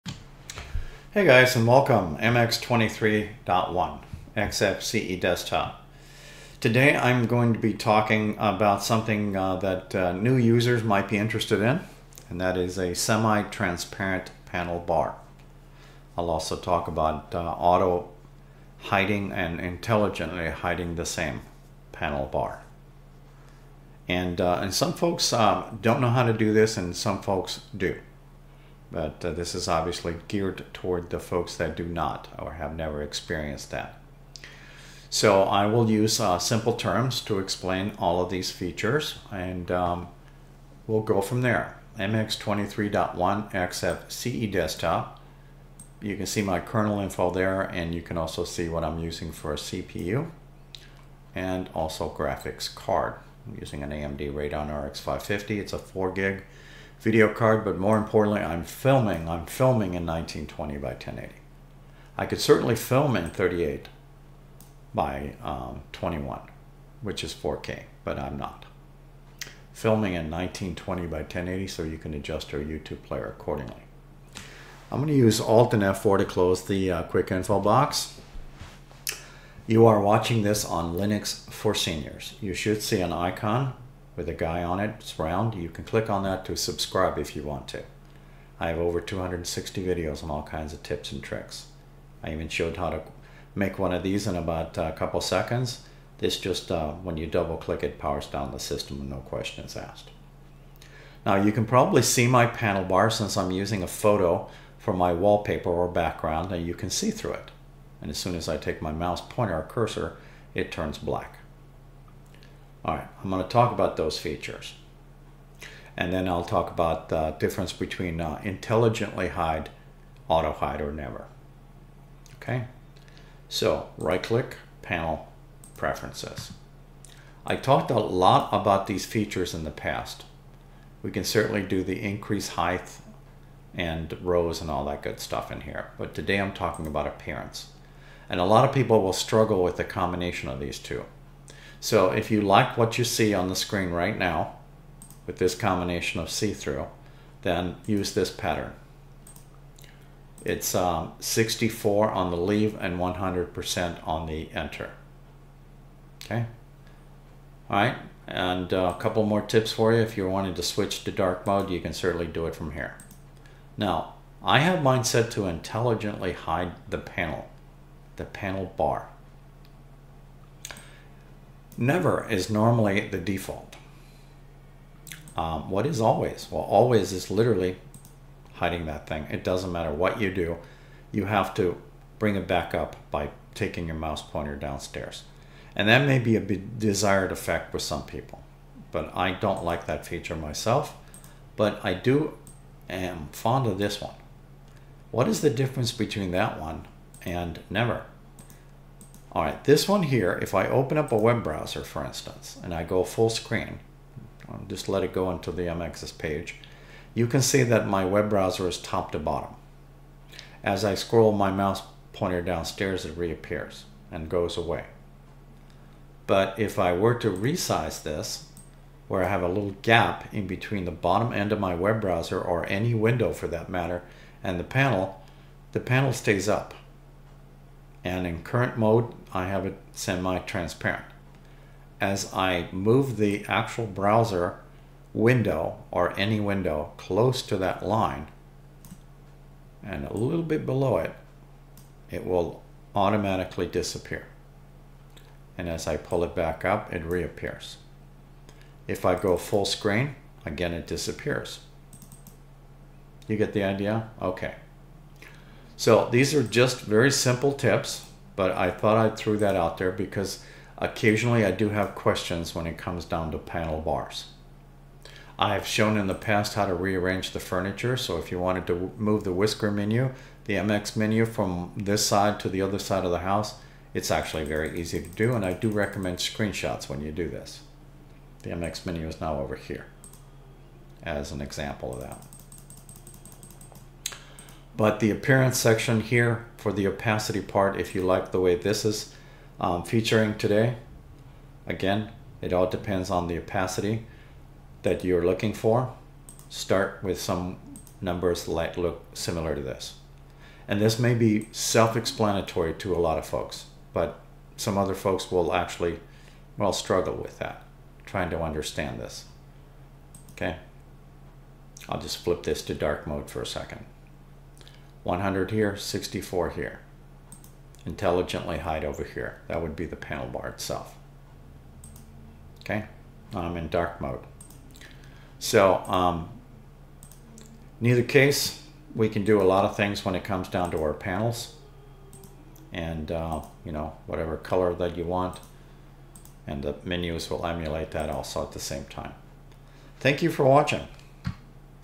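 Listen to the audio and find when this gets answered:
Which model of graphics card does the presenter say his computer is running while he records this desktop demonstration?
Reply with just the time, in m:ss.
0:53.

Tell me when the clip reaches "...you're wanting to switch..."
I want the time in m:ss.
2:40.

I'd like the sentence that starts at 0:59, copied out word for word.
I'm filming in 1920 by 1080.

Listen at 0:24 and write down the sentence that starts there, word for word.
And, uh, and some folks uh, don't know how to do this and some folks do.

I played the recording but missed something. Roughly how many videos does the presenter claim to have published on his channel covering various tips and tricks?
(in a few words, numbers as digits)
over 260.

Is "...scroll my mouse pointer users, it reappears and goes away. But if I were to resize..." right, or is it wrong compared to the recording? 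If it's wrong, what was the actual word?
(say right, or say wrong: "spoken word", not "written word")
wrong: "downstairs", not "users".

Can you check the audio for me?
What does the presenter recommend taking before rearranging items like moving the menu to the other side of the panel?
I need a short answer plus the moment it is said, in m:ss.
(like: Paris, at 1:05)
screenshots, at 4:36.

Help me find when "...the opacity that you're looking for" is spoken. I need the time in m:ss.
4:53.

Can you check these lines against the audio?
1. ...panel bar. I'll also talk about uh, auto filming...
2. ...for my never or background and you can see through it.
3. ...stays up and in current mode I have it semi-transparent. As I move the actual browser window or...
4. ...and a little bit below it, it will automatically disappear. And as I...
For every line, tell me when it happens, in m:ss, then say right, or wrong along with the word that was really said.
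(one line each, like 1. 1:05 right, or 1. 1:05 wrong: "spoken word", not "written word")
1. 0:14 wrong: "hiding", not "filming"
2. 1:44 wrong: "wallpaper", not "never"
3. 3:46 right
4. 3:59 right.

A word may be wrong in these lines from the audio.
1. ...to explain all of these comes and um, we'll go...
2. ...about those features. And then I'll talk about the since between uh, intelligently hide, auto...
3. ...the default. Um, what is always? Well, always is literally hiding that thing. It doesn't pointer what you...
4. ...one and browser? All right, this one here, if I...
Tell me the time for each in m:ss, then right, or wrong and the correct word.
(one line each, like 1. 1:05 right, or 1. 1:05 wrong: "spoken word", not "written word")
1. 0:37 wrong: "features", not "comes"
2. 1:53 wrong: "difference", not "since"
3. 2:53 wrong: "matter", not "pointer"
4. 3:16 wrong: "never", not "browser".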